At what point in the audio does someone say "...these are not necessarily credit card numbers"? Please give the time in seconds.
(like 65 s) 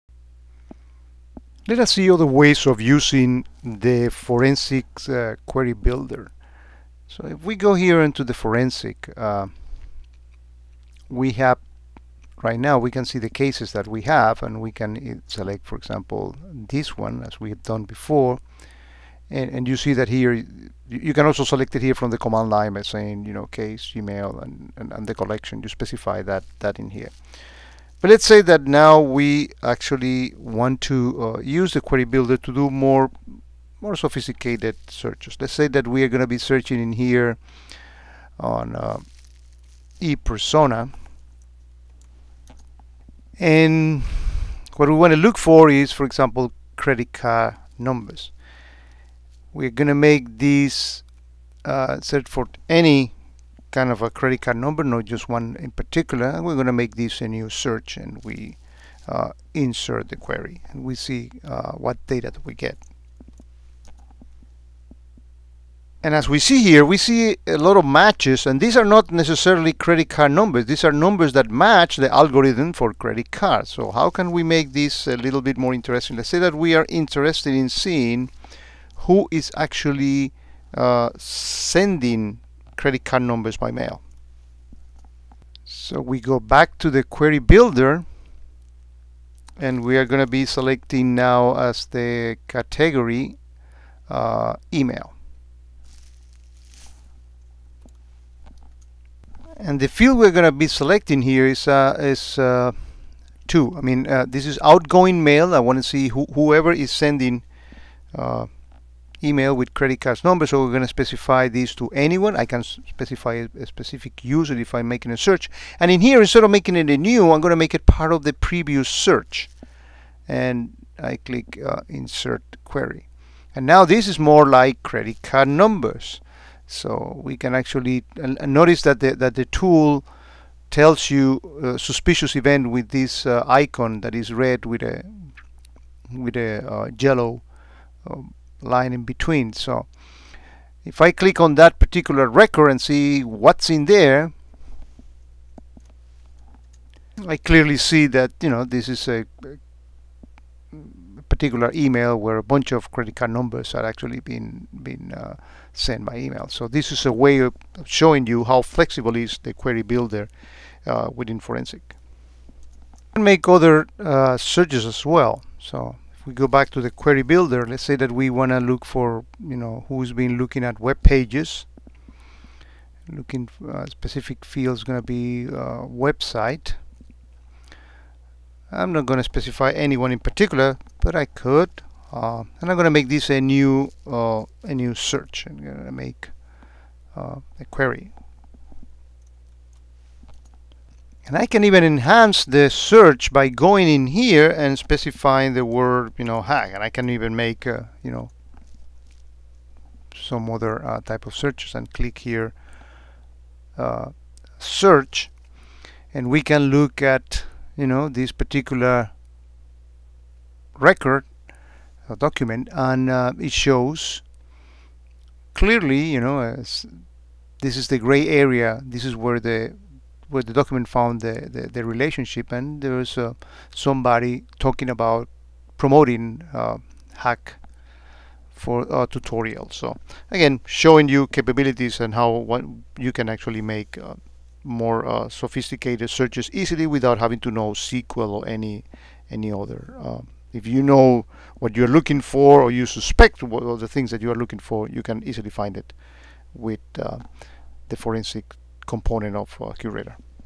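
68 s.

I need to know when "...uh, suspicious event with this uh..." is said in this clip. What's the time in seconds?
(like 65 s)
131 s.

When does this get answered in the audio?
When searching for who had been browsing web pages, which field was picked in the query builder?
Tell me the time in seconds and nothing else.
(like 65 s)
175 s.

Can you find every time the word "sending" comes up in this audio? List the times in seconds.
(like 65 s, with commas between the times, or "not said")
81 s, 106 s.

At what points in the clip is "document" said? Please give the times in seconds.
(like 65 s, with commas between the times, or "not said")
212 s, 220 s.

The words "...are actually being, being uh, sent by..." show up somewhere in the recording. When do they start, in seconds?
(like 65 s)
153 s.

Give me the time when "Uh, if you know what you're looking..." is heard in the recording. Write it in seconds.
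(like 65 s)
239 s.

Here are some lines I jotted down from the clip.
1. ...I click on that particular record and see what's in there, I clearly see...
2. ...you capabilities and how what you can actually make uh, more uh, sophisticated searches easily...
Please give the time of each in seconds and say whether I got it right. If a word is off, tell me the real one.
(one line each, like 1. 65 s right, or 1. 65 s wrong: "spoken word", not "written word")
1. 141 s right
2. 231 s right.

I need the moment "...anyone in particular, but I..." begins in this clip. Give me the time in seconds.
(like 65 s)
179 s.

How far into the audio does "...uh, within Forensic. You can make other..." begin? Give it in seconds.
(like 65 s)
160 s.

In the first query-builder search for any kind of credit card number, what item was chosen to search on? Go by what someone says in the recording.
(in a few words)
e-persona.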